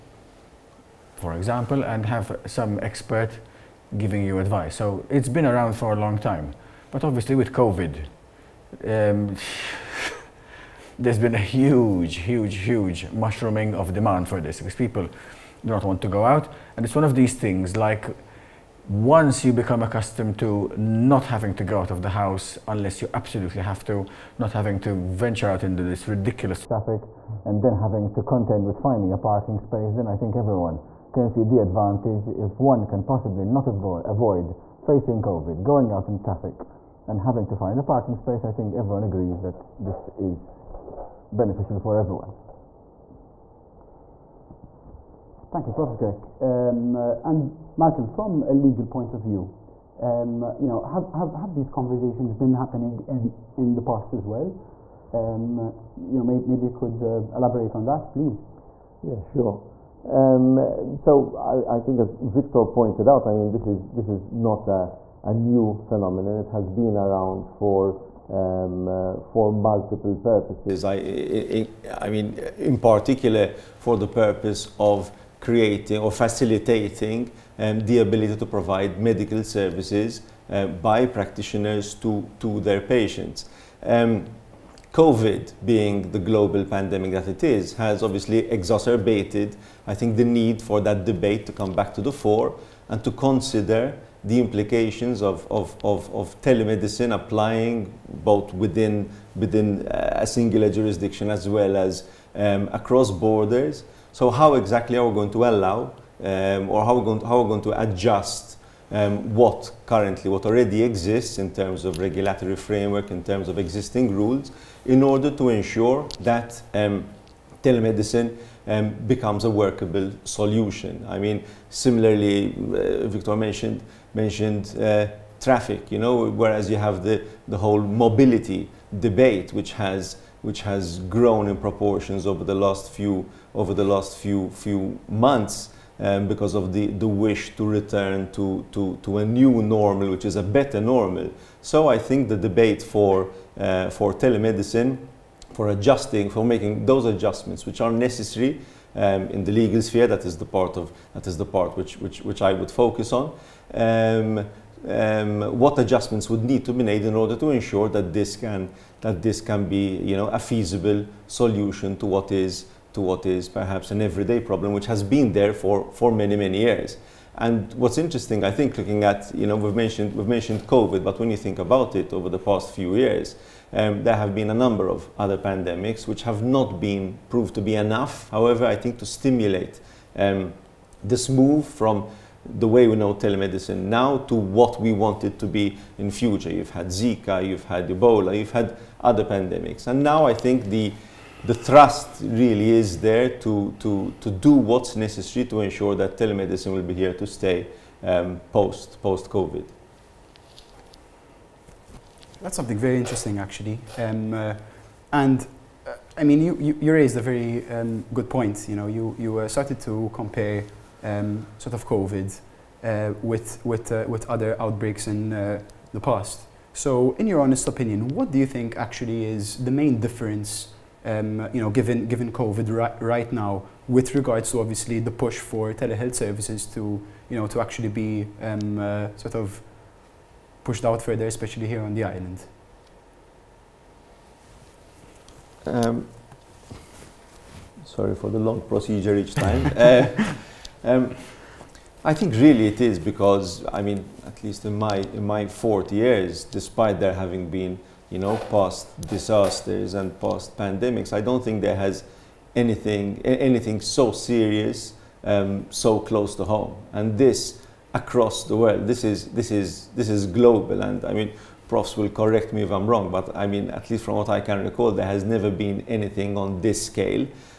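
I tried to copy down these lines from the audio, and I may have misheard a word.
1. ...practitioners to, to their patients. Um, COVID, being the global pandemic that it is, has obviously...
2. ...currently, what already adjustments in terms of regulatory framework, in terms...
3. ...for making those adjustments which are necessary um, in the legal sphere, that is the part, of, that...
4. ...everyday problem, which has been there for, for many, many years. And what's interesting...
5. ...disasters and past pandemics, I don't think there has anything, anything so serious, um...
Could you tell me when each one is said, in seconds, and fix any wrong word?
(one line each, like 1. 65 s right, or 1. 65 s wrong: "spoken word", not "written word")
1. 81 s right
2. 109 s wrong: "exists", not "adjustments"
3. 146 s right
4. 164 s right
5. 249 s right.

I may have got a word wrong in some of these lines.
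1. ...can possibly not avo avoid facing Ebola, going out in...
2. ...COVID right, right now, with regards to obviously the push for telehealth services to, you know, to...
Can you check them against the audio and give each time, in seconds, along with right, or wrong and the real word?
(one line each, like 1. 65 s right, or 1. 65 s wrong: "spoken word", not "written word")
1. 32 s wrong: "COVID", not "Ebola"
2. 222 s right.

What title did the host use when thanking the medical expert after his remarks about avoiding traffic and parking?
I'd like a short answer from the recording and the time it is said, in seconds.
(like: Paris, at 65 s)
Professor Grech, at 45 s.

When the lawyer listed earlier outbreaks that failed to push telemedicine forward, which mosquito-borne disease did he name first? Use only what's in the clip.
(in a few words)
Zika.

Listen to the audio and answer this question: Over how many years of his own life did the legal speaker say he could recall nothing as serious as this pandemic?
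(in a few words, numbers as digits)
40.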